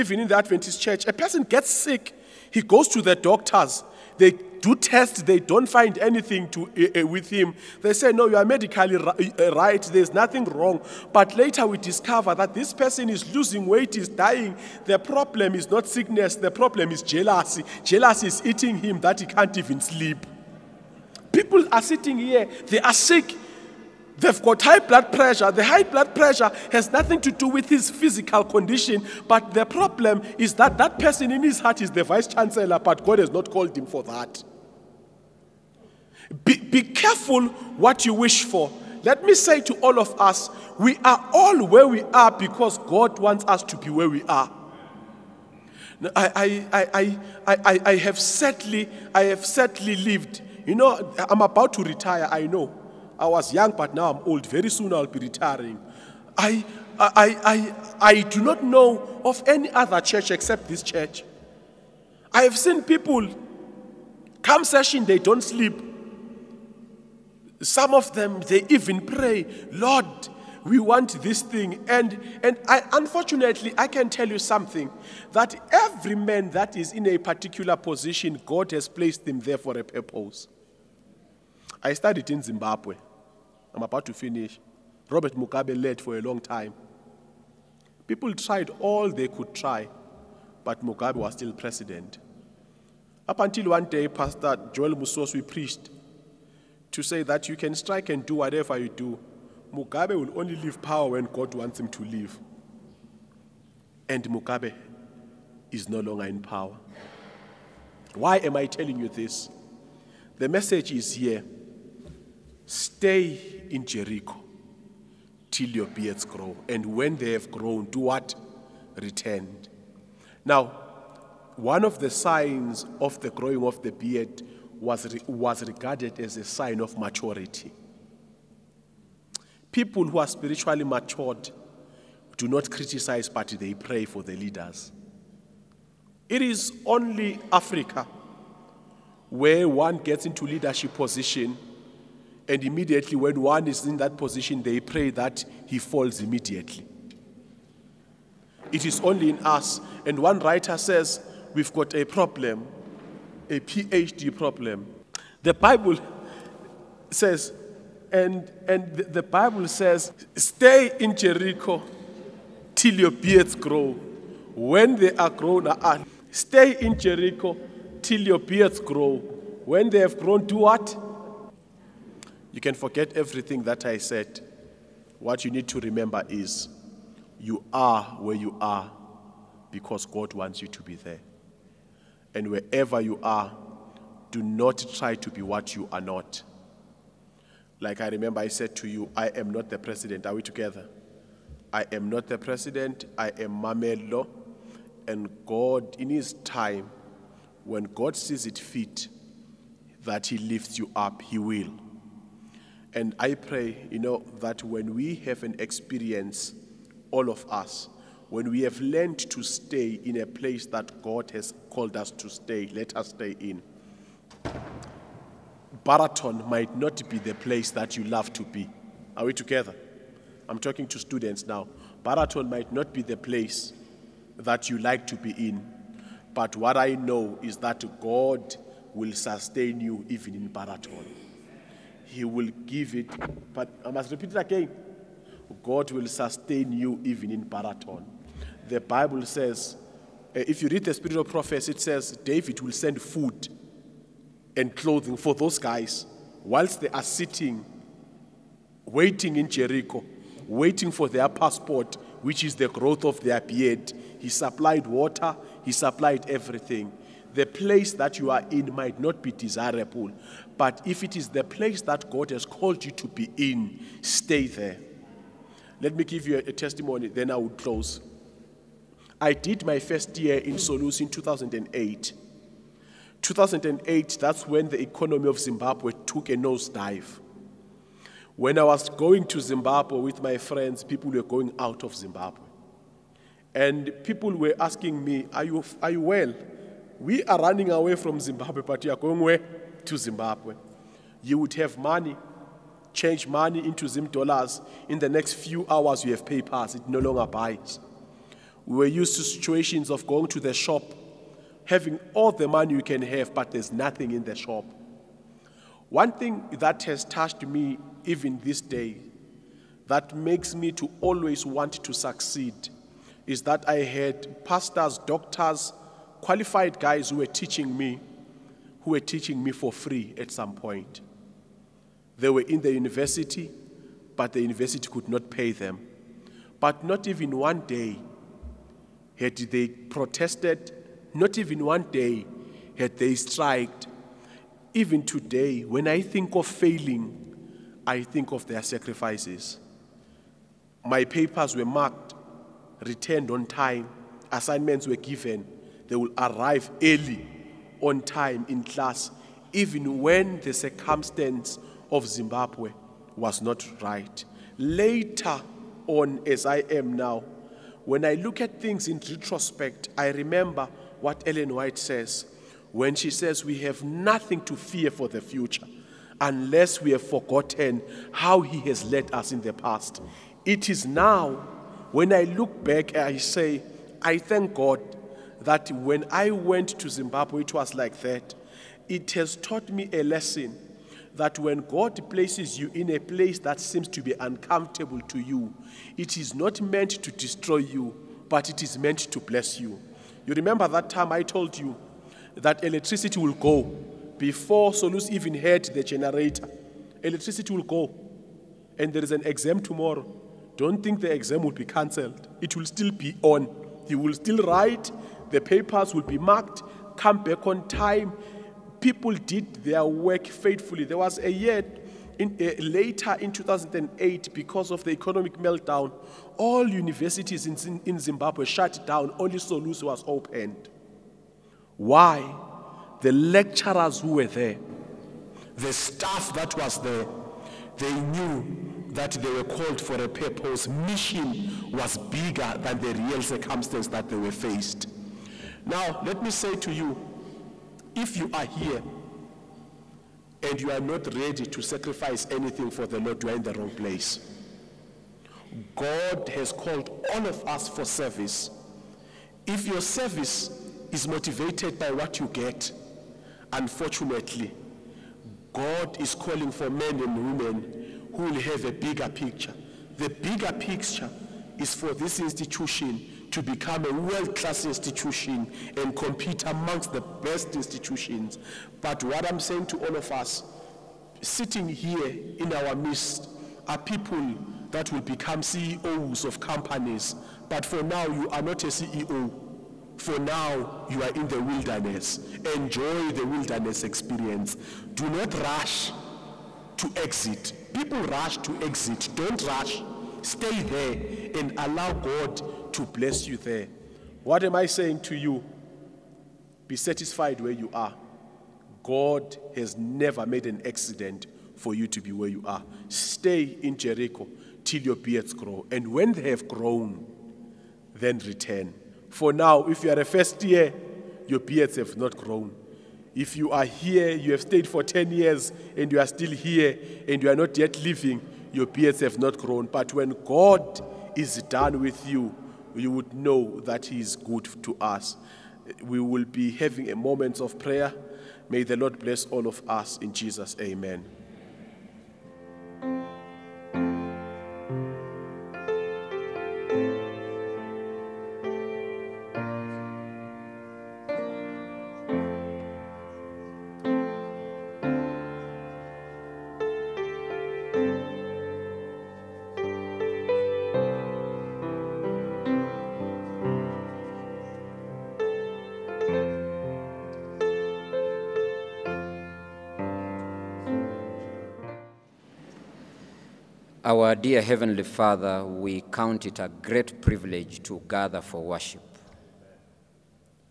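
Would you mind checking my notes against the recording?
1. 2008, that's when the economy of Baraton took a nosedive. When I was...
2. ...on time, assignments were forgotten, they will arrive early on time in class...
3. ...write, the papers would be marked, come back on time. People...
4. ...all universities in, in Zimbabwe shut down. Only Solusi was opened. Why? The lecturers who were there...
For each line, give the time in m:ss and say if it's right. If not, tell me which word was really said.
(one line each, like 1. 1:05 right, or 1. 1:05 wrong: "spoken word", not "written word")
1. 4:33 wrong: "Zimbabwe", not "Baraton"
2. 5:43 wrong: "given", not "forgotten"
3. 6:44 right
4. 6:56 right.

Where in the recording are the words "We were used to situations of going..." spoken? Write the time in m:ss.
4:58.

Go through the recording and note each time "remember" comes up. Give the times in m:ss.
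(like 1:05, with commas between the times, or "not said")
2:55, 3:08, 6:00, 6:30.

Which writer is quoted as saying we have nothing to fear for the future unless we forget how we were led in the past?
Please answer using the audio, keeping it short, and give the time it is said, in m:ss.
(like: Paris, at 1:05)
Ellen White, at 6:01.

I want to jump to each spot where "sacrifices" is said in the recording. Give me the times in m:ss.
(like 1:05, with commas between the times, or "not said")
5:38, 7:21.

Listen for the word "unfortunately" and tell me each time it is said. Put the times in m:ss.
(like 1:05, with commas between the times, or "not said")
1:12, 7:33.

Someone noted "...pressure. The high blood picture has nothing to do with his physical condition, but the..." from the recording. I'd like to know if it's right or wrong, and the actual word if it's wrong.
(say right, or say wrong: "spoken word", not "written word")
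wrong: "pressure", not "picture".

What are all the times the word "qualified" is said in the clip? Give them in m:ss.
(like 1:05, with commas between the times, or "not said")
5:16.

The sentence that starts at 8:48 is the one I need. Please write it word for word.
May the Lord bless all of us in Jesus.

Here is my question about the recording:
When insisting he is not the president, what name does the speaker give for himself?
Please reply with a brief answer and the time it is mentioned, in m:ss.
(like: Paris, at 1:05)
Mamello, at 3:13.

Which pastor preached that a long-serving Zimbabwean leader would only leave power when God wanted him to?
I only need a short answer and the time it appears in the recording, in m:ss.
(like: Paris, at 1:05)
Joel Musoswe, at 1:34.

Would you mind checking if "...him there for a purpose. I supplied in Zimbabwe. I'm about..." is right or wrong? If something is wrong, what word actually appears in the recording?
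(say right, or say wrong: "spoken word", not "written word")
wrong: "studied", not "supplied".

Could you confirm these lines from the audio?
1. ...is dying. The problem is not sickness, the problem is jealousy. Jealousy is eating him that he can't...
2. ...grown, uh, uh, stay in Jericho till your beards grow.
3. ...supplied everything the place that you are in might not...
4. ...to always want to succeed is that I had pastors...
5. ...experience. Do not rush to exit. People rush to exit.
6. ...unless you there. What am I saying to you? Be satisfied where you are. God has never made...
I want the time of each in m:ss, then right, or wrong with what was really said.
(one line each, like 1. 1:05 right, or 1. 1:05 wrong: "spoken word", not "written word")
1. 0:13 right
2. 2:45 right
3. 4:15 right
4. 5:10 right
5. 8:03 right
6. 8:12 wrong: "bless", not "unless".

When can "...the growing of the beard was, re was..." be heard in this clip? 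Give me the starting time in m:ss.
2:03.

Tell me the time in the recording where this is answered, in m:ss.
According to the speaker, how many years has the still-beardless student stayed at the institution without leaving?
8:34.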